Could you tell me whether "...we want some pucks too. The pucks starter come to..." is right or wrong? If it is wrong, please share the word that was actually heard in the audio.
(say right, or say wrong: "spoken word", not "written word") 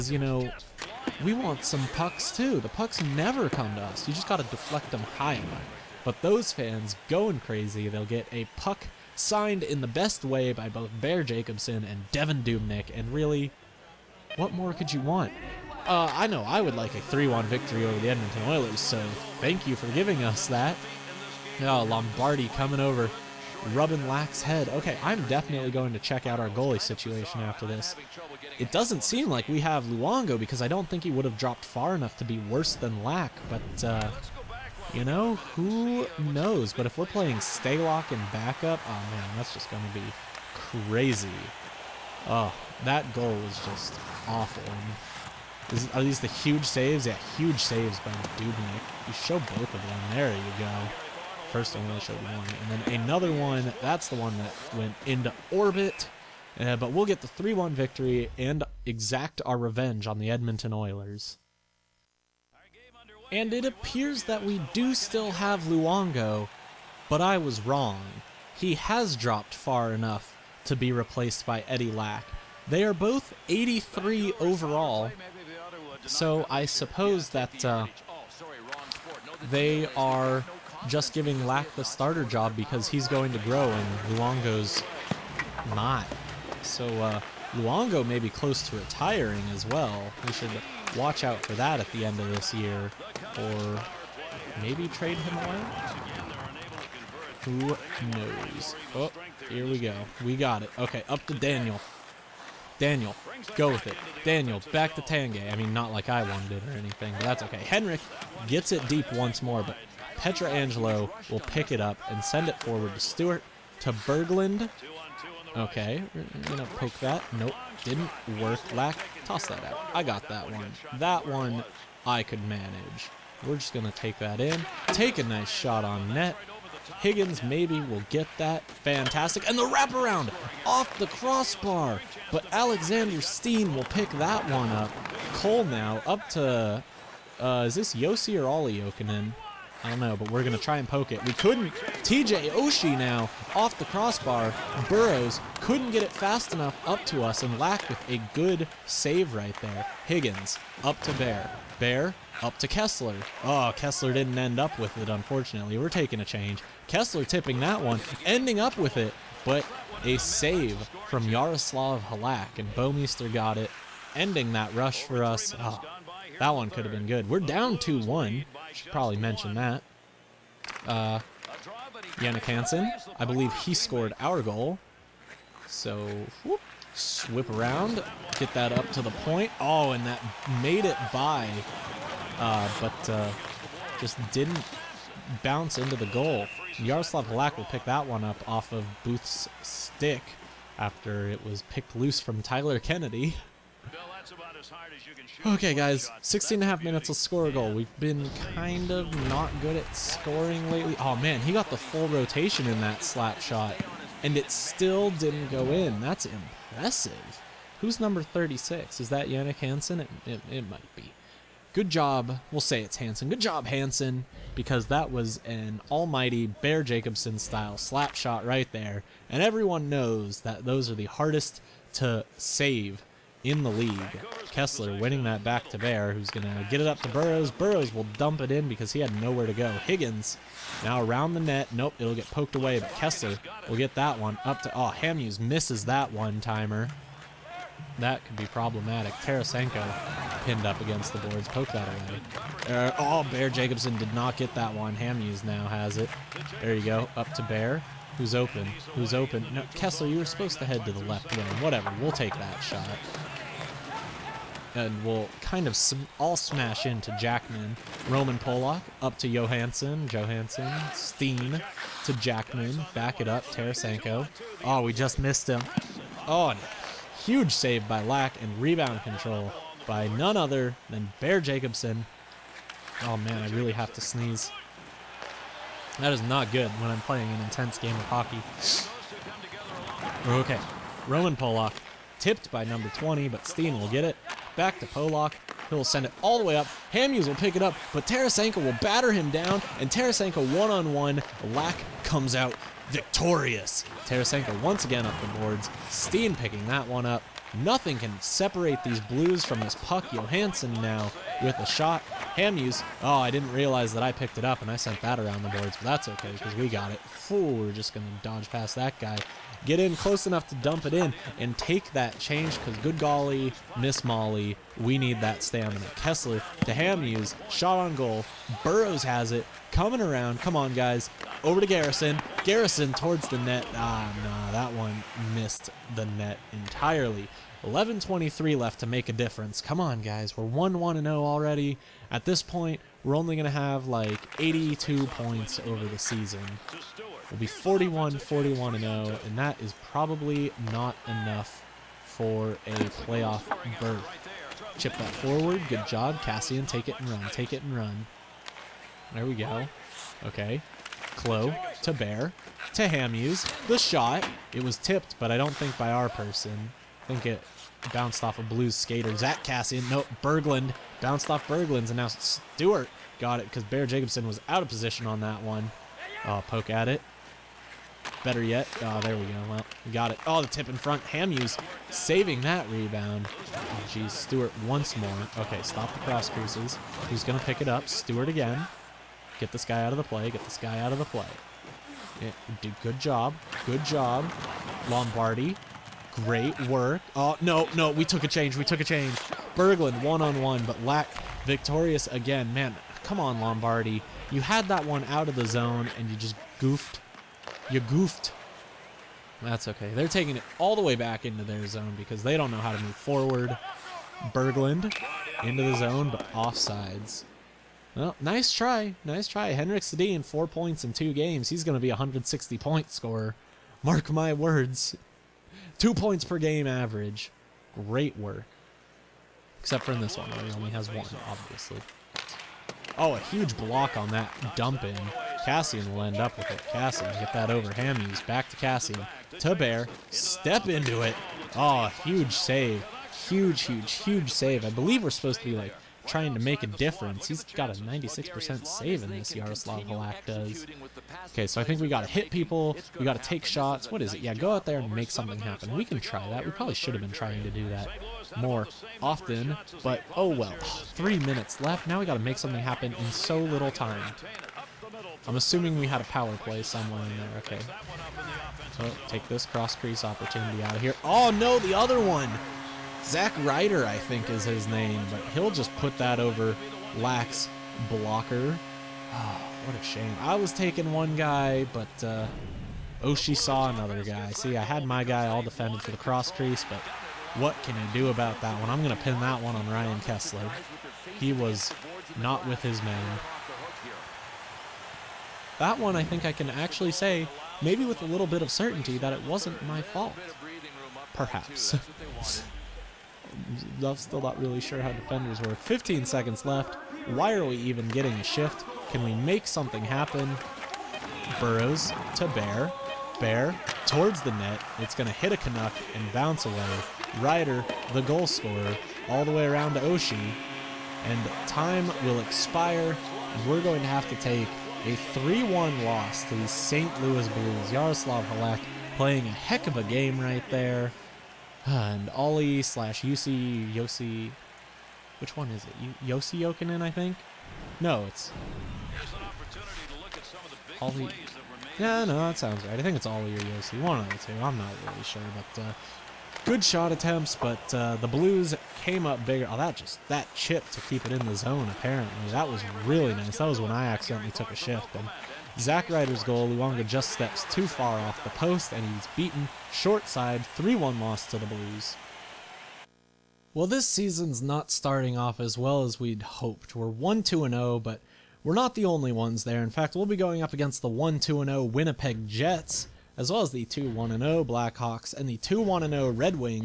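wrong: "never", not "starter".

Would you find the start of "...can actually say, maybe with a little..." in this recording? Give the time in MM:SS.
08:06.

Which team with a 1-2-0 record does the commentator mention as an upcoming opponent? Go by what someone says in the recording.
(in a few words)
Winnipeg Jets.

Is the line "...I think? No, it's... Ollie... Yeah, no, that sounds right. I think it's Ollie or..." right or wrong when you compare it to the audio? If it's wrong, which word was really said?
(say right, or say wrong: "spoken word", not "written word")
right.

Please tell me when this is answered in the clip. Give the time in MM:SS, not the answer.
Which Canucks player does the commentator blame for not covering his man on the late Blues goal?
07:59.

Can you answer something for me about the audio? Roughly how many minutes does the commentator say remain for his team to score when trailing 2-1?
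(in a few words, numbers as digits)
16 and a half.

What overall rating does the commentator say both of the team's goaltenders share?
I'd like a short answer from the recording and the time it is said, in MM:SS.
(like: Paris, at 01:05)
83, at 01:13.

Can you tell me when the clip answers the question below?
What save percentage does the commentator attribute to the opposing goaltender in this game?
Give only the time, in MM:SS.
07:17.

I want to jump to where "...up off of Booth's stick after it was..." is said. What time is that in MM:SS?
03:08.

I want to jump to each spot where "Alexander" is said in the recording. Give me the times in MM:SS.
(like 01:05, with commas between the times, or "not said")
02:12.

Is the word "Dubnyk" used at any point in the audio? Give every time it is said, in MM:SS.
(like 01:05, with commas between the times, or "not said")
00:12, 00:48.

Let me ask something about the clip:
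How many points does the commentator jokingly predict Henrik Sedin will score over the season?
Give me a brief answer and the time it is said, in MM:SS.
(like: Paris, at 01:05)
160, at 06:51.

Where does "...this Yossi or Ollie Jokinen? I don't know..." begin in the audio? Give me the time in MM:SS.
02:17.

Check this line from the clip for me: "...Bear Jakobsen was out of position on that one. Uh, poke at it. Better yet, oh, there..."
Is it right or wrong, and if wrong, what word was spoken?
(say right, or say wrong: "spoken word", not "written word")
right.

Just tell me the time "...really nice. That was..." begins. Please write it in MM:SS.
09:02.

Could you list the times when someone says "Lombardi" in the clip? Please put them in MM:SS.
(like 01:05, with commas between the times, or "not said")
00:21, 06:24, 06:33.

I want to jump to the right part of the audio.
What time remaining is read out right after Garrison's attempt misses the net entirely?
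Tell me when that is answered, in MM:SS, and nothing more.
05:27.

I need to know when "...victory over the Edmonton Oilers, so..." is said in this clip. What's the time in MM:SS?
00:17.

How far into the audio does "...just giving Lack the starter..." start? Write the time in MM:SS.
01:20.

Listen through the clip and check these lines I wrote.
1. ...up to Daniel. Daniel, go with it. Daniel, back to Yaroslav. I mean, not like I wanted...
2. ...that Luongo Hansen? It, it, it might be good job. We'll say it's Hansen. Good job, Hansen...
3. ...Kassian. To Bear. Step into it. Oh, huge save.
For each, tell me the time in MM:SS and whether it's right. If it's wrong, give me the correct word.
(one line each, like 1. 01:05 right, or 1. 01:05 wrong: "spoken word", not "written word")
1. 01:41 wrong: "Tanguay", not "Yaroslav"
2. 03:29 wrong: "Jannik", not "Luongo"
3. 07:08 right.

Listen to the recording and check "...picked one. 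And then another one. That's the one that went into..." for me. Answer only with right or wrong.
wrong.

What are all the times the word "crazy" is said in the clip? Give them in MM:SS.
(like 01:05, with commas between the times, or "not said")
00:07, 00:40.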